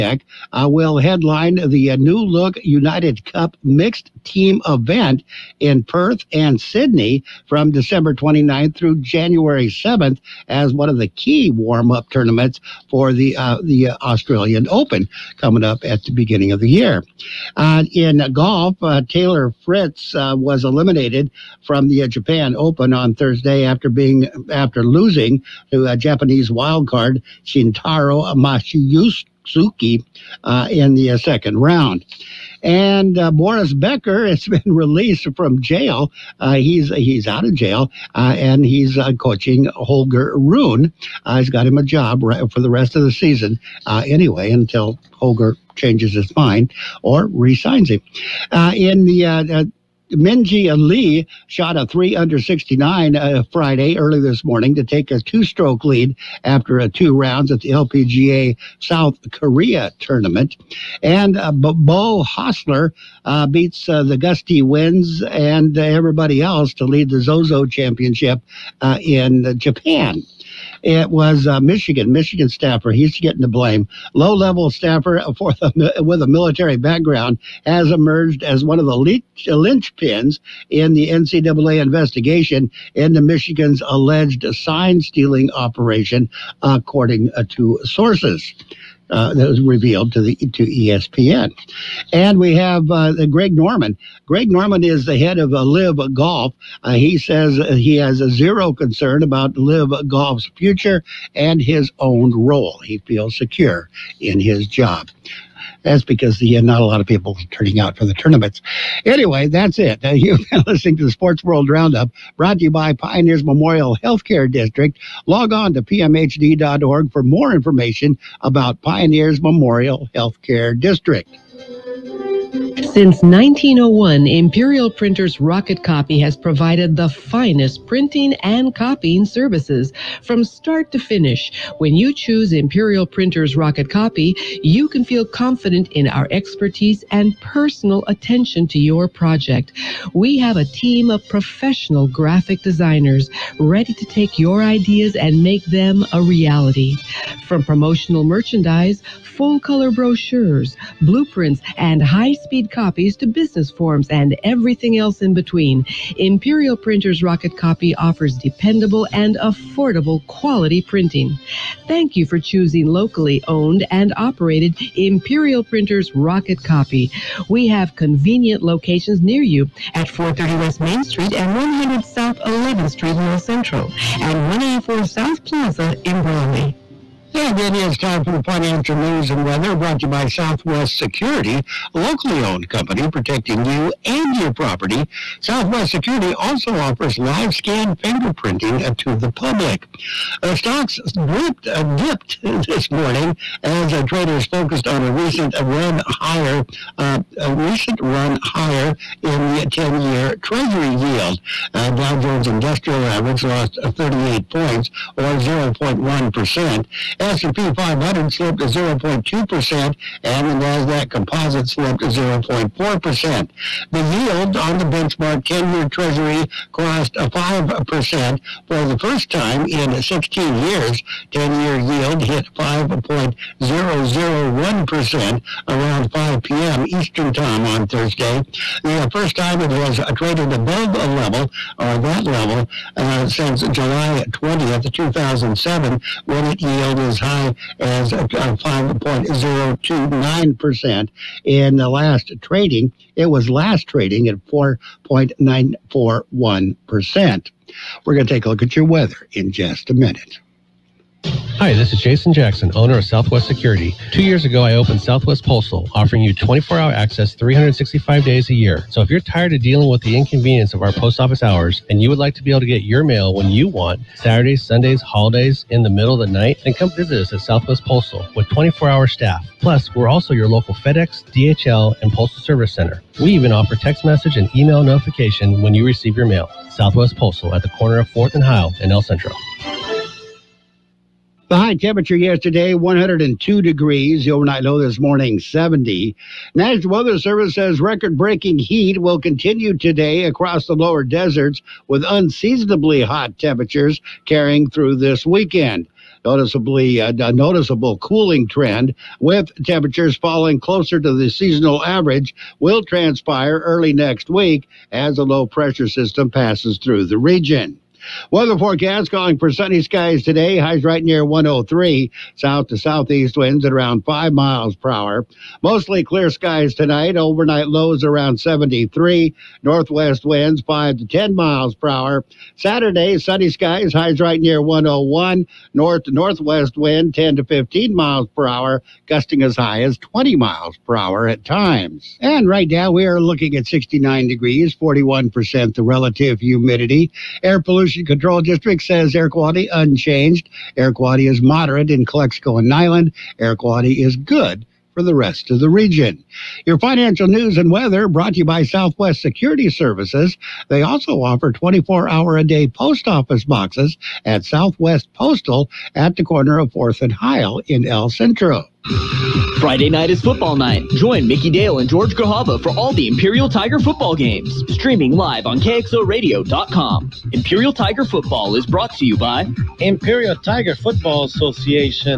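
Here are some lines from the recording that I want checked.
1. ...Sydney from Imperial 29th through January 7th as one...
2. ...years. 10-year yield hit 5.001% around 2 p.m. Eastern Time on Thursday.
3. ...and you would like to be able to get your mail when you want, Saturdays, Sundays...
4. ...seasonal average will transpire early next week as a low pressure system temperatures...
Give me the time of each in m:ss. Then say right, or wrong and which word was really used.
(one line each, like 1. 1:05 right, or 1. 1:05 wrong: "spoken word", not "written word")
1. 0:06 wrong: "December", not "Imperial"
2. 3:40 wrong: "5", not "2"
3. 4:21 right
4. 5:01 wrong: "passes", not "temperatures".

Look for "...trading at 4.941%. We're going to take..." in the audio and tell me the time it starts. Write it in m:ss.
4:03.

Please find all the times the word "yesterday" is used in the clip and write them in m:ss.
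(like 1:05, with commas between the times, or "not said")
4:42.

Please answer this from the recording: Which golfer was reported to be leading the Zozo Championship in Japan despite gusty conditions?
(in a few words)
Beau Hossler.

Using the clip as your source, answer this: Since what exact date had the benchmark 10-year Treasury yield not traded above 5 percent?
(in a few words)
July 20th, 2007.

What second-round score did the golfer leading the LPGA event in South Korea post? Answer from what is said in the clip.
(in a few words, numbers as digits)
3 under 69.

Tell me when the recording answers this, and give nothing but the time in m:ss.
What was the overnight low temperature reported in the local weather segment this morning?
4:45.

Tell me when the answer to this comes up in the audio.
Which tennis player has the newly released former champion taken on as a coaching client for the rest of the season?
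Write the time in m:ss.
0:39.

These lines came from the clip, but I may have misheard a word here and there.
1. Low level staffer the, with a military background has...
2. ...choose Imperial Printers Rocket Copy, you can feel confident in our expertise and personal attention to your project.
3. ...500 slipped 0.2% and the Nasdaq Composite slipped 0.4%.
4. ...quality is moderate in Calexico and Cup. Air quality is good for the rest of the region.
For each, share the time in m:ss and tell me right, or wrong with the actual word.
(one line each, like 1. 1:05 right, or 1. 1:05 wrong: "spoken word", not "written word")
1. 1:14 right
2. 2:12 right
3. 3:27 right
4. 5:40 wrong: "Niland", not "Cup".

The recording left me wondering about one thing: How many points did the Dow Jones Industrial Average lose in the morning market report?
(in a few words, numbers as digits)
38.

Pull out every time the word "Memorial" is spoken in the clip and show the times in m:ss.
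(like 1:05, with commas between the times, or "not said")
1:53, 1:59.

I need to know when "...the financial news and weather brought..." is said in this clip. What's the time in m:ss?
2:58.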